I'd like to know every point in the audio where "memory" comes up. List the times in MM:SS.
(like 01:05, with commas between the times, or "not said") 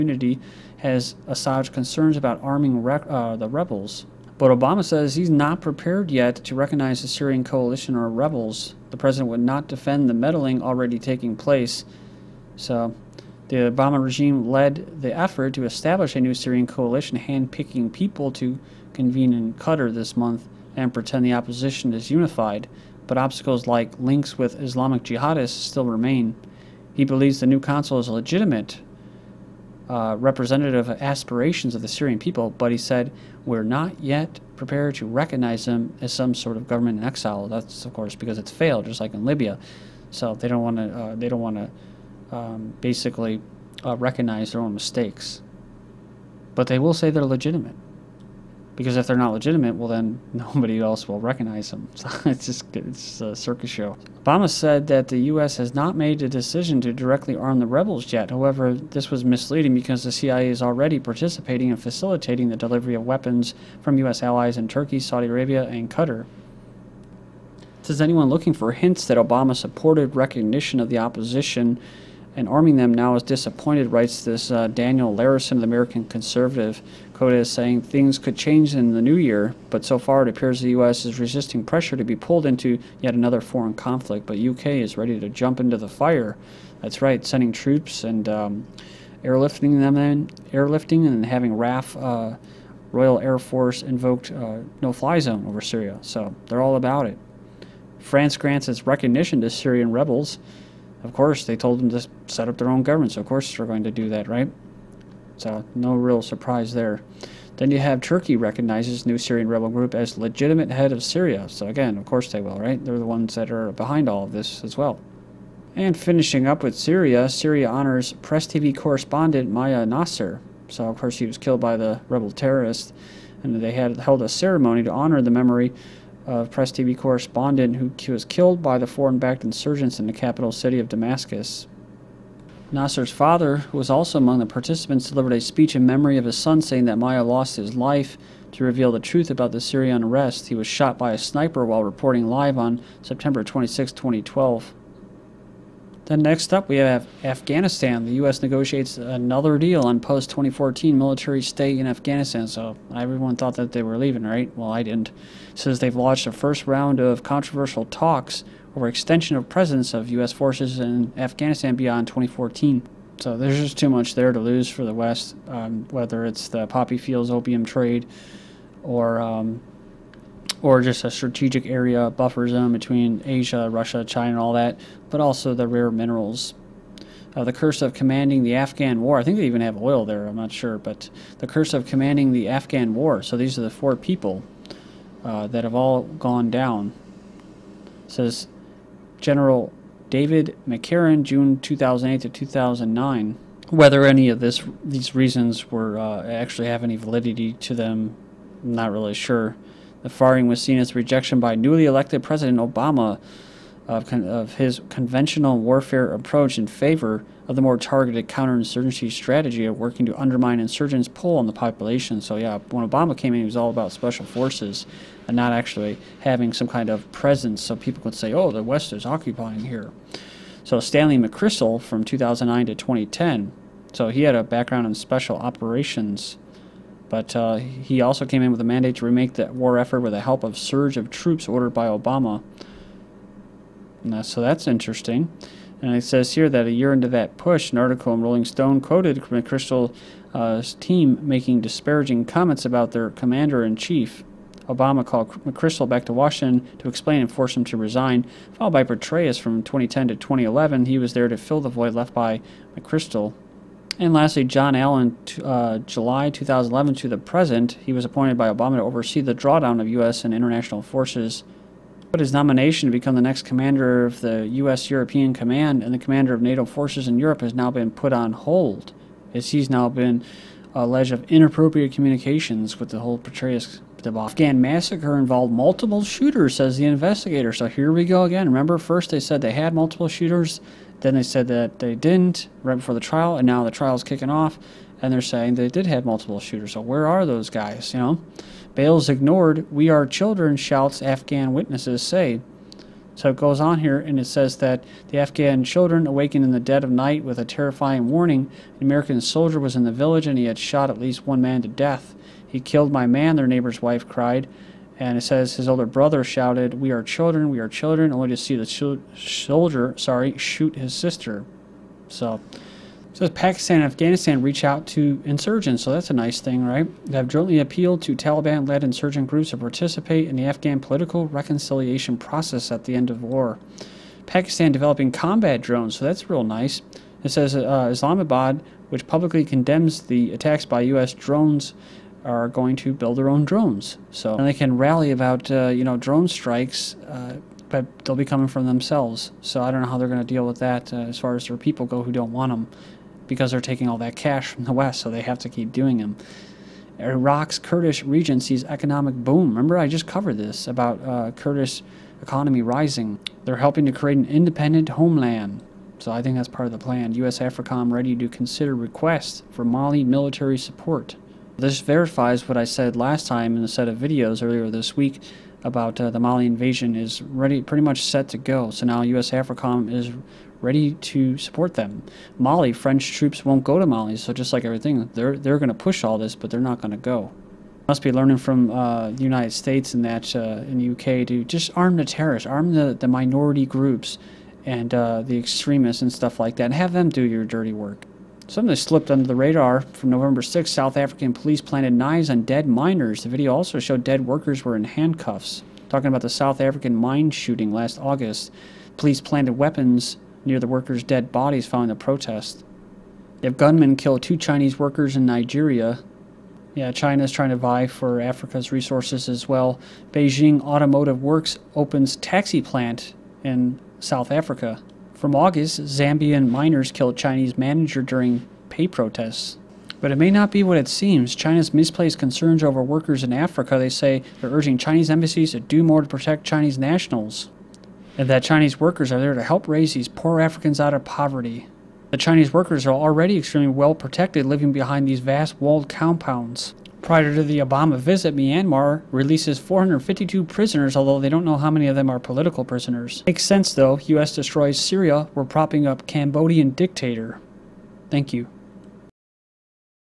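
02:05, 02:15.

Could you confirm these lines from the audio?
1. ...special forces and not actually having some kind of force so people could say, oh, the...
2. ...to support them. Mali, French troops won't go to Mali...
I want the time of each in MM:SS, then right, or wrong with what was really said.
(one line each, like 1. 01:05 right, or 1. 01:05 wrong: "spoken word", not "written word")
1. 03:33 wrong: "presence", not "force"
2. 06:10 right.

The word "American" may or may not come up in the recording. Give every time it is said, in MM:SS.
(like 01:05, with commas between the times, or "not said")
01:15, 04:58.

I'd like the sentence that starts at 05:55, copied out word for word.
So I think that's part of the plan.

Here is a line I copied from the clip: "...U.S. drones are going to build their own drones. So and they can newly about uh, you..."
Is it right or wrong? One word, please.
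wrong.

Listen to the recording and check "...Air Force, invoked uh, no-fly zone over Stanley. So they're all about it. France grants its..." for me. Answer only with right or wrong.
wrong.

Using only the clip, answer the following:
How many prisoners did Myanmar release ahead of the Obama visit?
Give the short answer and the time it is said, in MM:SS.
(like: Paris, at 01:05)
452, at 07:19.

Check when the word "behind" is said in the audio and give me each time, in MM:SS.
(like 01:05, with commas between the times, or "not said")
01:53, 07:14.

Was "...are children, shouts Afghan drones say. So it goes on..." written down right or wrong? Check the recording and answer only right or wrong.
wrong.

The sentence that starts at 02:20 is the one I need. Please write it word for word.
He was shot by a sniper while reporting live on September 26, 2012.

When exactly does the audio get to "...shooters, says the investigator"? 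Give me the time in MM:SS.
04:36.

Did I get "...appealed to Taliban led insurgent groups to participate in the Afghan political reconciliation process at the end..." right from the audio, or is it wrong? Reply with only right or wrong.
right.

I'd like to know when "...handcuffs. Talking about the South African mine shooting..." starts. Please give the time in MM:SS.
06:34.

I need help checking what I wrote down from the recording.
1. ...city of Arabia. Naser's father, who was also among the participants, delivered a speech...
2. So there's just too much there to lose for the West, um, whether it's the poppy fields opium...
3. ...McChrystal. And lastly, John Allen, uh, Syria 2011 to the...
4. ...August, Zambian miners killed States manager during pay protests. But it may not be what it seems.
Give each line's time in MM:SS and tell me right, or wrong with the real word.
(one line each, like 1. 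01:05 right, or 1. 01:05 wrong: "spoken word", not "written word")
1. 02:10 wrong: "Damascus", not "Arabia"
2. 02:43 right
3. 04:12 wrong: "July", not "Syria"
4. 06:55 wrong: "Chinese", not "States".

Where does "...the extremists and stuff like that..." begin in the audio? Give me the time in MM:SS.
06:25.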